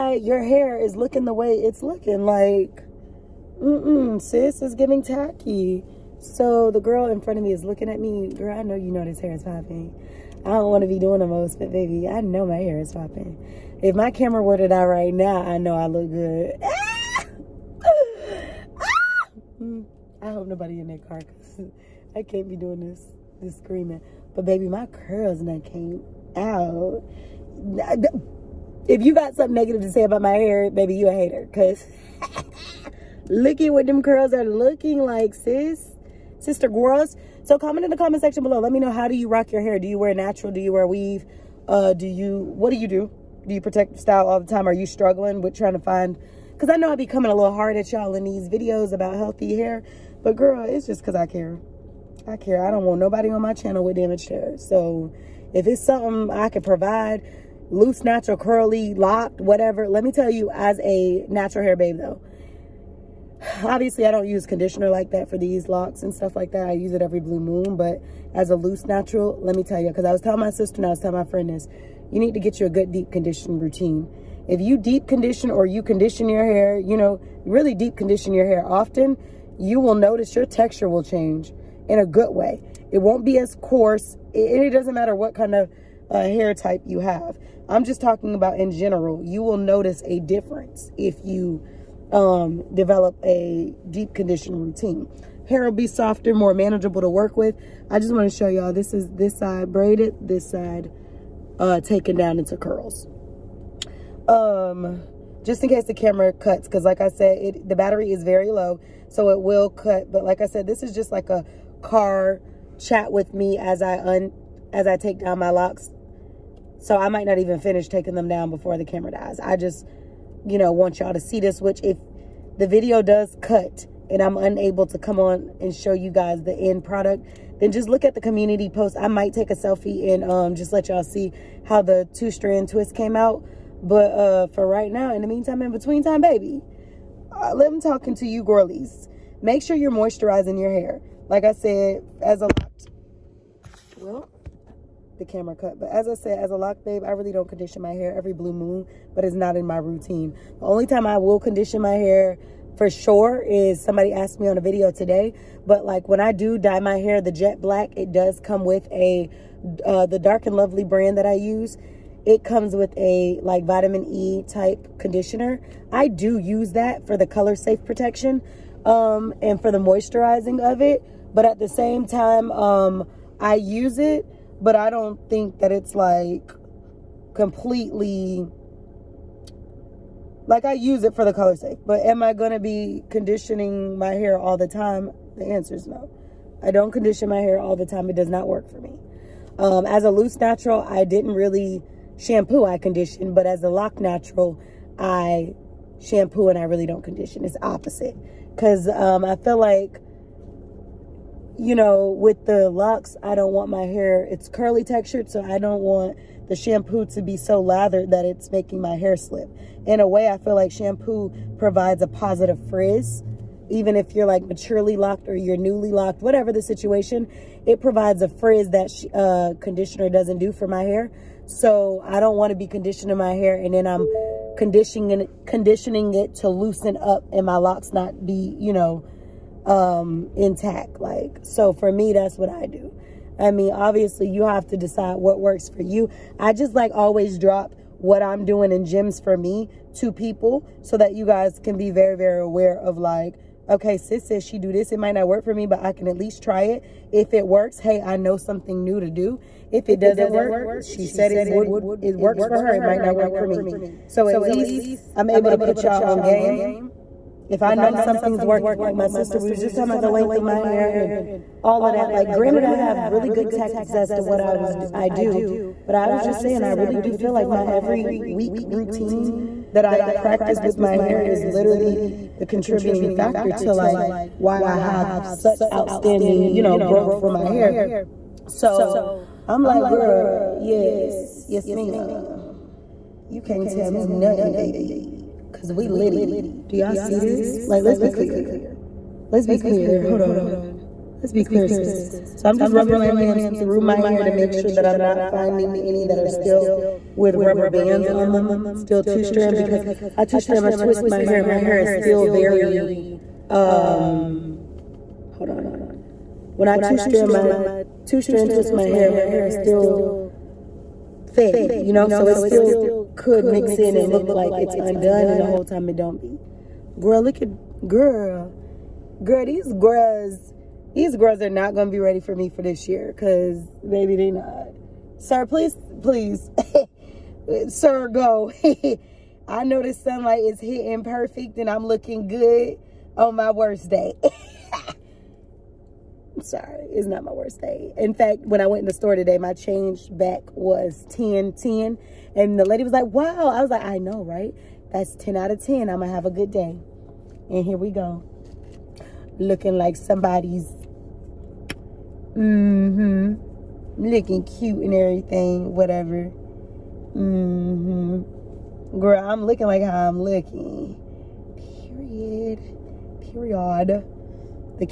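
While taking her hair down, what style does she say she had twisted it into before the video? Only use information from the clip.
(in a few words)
two strand twist.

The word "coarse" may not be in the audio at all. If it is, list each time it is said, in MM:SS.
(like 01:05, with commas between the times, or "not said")
01:23.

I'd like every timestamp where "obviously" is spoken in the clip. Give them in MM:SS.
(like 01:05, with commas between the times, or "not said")
01:03, 03:53.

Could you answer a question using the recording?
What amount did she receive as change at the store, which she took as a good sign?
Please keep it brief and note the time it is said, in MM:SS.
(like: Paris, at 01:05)
10.10, at 05:41.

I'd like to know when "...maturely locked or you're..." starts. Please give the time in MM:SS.
03:34.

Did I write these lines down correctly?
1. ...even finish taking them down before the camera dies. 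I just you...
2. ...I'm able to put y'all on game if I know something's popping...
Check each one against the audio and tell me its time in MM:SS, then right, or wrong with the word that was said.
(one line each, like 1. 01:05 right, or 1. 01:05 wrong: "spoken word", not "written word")
1. 01:57 right
2. 04:15 wrong: "working", not "popping".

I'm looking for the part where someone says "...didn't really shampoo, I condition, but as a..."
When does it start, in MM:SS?
03:11.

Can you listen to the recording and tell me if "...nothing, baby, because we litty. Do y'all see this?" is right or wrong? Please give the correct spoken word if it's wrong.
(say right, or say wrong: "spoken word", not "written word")
right.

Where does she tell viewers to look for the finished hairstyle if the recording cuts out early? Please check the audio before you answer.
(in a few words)
community post.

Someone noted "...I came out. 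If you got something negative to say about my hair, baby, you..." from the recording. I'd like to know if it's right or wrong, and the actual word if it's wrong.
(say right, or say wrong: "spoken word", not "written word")
right.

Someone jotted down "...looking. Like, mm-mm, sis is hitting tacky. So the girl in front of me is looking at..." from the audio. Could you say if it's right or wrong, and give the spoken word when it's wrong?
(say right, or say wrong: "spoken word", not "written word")
wrong: "giving", not "hitting".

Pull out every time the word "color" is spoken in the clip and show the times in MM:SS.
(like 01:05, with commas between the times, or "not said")
02:47, 03:01.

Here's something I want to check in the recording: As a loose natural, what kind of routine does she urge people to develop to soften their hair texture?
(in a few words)
deep conditioning routine.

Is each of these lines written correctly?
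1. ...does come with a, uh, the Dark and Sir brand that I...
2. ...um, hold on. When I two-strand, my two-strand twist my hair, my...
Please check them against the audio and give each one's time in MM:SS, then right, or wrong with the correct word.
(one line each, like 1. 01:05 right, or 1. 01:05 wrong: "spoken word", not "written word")
1. 02:38 wrong: "Lovely", not "Sir"
2. 05:03 right.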